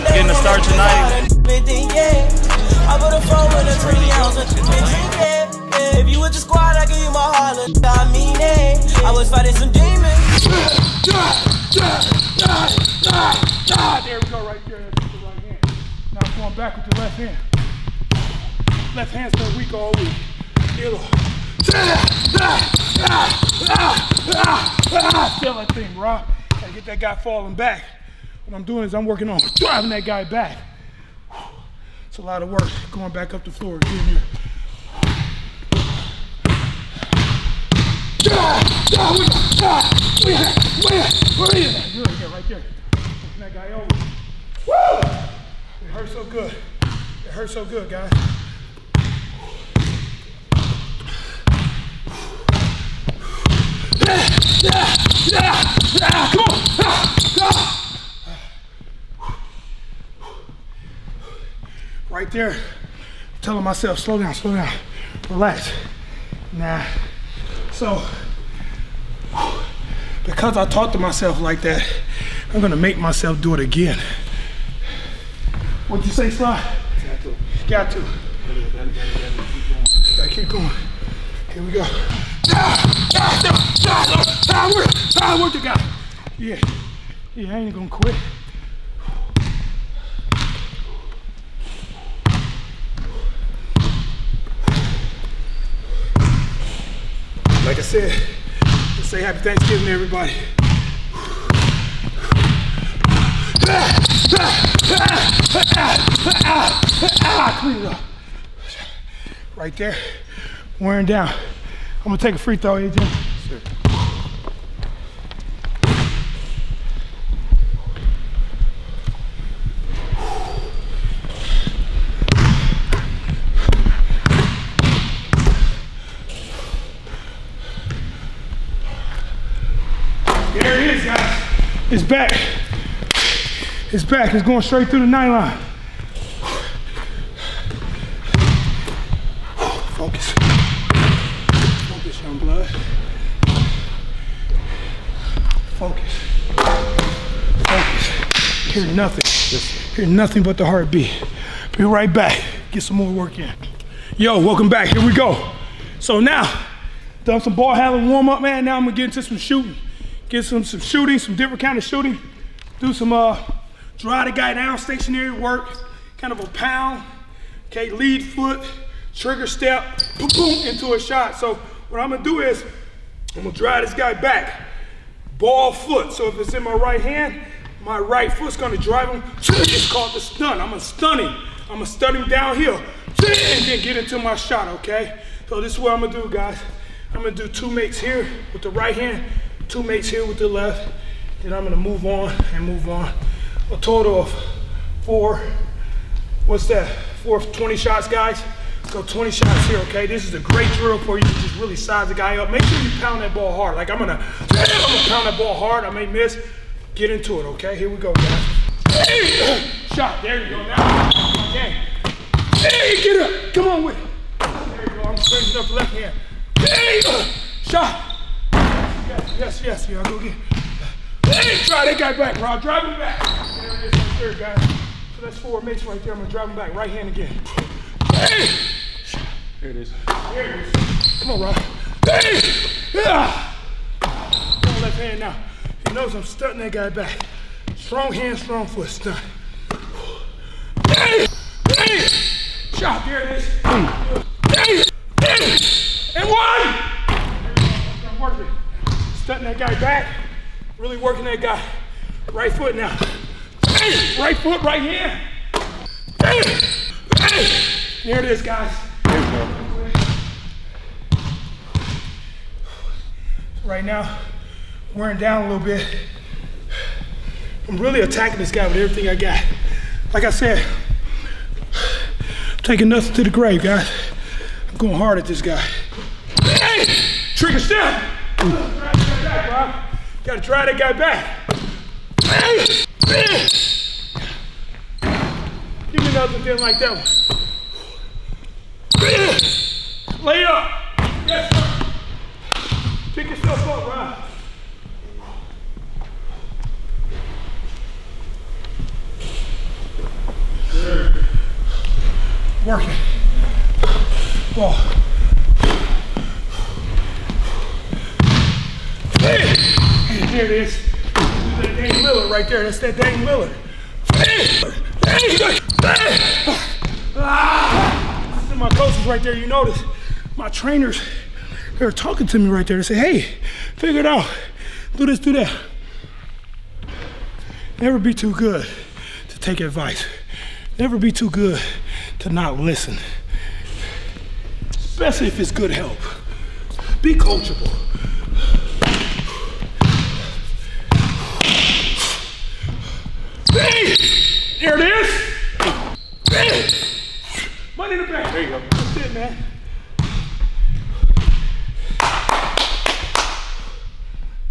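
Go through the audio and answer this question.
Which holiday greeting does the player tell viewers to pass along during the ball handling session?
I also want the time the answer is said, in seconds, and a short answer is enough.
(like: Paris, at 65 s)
Happy Thanksgiving, at 99 s.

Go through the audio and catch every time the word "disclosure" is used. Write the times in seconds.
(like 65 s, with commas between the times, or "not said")
not said.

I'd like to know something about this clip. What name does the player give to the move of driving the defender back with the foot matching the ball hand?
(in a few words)
The stun.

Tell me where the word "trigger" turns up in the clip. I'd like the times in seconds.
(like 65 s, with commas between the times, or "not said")
169 s, 277 s.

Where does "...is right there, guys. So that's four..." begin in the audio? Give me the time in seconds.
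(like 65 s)
223 s.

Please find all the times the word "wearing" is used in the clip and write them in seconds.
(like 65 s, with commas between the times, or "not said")
110 s, 264 s.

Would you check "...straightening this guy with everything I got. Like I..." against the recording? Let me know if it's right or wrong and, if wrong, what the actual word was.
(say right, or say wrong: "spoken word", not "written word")
wrong: "attacking", not "straightening".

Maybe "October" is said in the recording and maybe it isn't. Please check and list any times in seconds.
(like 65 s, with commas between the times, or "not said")
not said.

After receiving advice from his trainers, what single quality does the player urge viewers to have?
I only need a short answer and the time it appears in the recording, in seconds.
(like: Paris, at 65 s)
Coachable, at 337 s.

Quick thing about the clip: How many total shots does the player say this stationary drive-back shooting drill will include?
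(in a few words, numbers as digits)
20.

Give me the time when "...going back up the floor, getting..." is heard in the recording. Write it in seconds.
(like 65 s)
32 s.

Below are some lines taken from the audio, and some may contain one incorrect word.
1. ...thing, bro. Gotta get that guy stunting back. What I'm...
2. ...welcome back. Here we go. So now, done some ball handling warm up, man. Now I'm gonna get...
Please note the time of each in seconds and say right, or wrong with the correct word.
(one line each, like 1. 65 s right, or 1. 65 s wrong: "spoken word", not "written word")
1. 25 s wrong: "falling", not "stunting"
2. 154 s right.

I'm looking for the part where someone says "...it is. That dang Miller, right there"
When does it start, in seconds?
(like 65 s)
310 s.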